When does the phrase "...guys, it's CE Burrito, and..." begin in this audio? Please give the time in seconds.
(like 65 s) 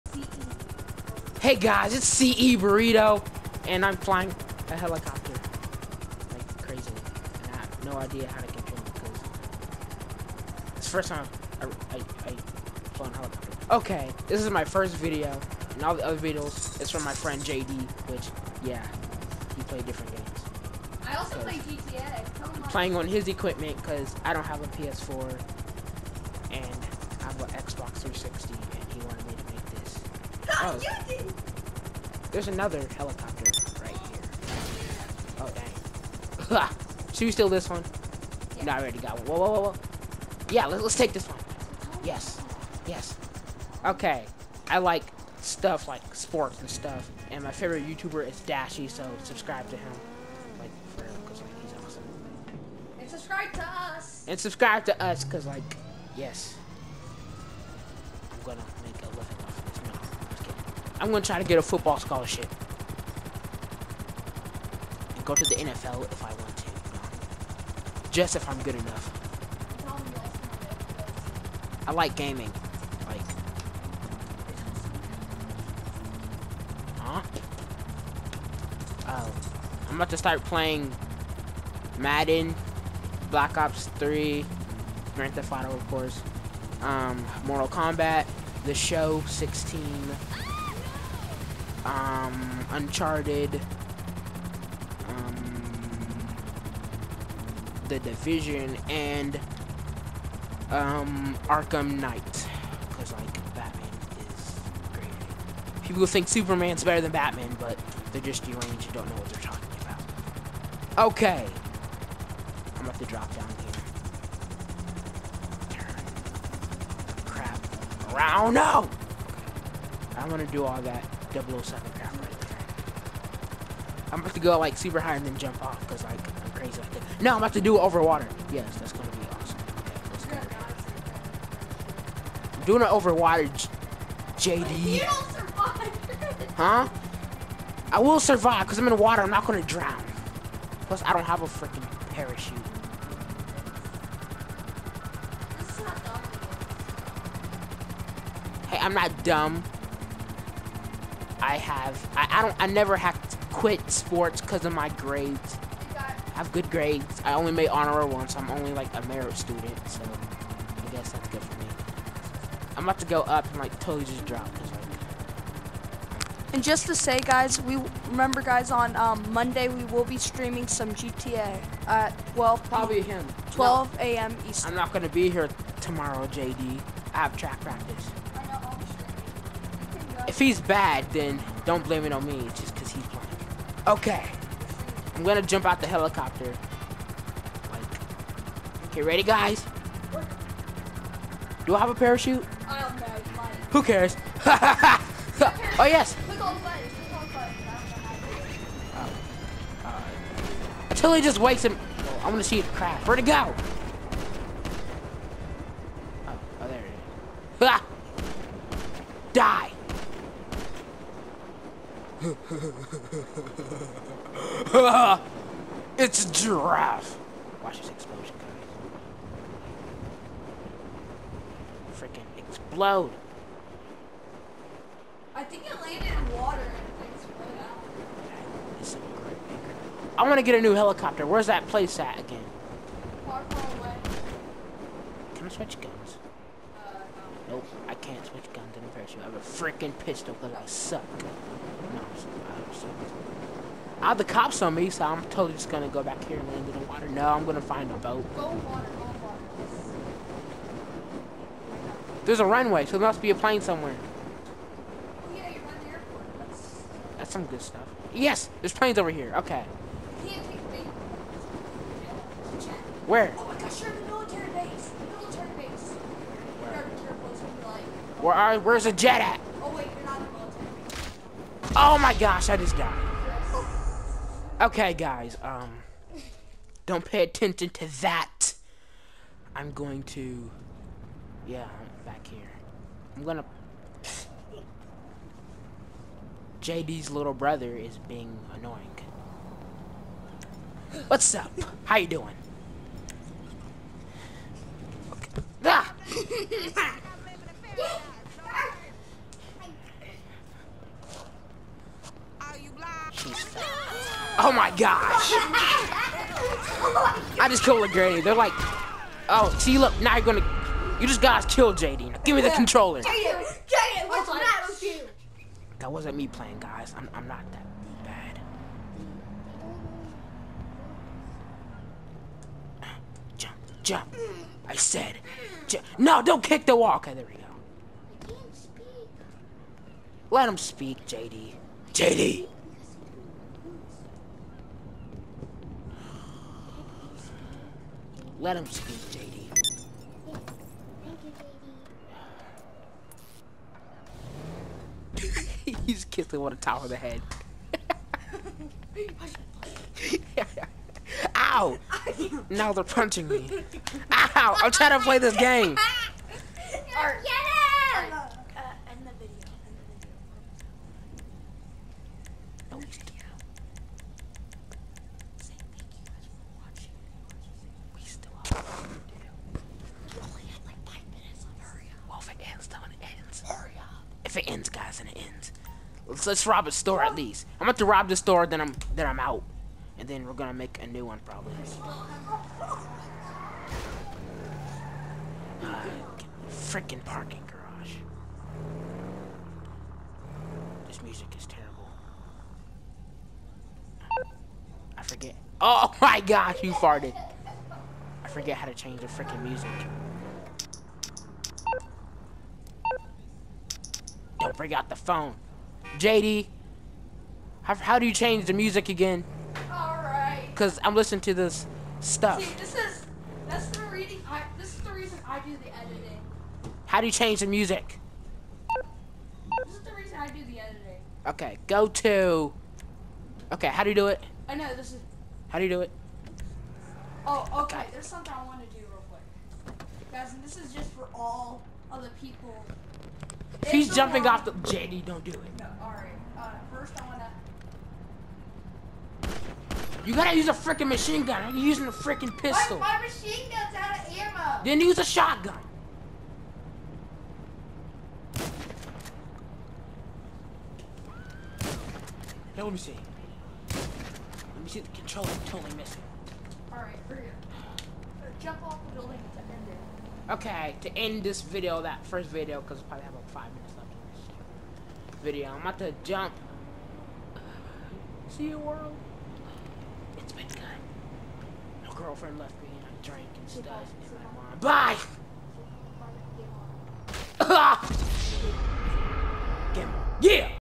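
1 s.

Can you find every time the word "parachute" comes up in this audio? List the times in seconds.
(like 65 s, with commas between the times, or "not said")
142 s, 191 s, 238 s.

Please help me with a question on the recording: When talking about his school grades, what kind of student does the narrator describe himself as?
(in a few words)
Merit student.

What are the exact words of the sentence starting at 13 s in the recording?
Okay, this is my first video, and all the other videos is from my friend JD, which yeah, he played different games.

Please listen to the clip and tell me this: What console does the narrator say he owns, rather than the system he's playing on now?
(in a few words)
Xbox 360.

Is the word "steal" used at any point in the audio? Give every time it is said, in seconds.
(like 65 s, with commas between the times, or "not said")
37 s.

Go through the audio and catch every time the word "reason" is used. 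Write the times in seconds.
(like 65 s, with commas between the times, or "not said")
414 s, 419 s.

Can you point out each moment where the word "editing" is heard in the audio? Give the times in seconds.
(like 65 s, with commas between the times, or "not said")
415 s, 420 s.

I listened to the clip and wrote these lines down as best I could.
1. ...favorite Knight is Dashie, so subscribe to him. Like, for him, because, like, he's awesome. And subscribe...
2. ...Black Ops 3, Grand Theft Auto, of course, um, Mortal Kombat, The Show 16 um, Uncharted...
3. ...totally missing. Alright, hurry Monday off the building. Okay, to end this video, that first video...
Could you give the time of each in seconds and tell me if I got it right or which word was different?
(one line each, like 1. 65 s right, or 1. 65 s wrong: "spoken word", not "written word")
1. 47 s wrong: "YouTuber", not "Knight"
2. 83 s right
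3. 455 s wrong: "Jump", not "Monday".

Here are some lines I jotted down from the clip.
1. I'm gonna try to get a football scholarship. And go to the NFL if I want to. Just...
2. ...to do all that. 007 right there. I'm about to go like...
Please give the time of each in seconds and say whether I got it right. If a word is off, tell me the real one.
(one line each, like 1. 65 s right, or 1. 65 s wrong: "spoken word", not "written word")
1. 61 s right
2. 120 s right.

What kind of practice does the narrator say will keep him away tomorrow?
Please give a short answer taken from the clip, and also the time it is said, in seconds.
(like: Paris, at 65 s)
Track practice, at 177 s.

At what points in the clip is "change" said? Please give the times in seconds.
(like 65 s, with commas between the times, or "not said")
398 s, 408 s, 417 s.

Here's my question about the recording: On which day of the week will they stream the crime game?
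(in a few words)
Monday.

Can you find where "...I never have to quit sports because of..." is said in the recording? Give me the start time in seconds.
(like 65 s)
152 s.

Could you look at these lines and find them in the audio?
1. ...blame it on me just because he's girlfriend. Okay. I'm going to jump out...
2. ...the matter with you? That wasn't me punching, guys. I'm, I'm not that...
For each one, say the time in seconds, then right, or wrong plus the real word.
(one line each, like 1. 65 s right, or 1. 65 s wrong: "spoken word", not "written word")
1. 181 s wrong: "blind", not "girlfriend"
2. 314 s wrong: "playing", not "punching".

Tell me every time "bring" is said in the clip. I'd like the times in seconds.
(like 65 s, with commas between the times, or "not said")
404 s.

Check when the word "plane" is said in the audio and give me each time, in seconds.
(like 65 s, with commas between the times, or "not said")
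253 s, 258 s.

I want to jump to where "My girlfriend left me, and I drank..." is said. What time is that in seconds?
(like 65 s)
471 s.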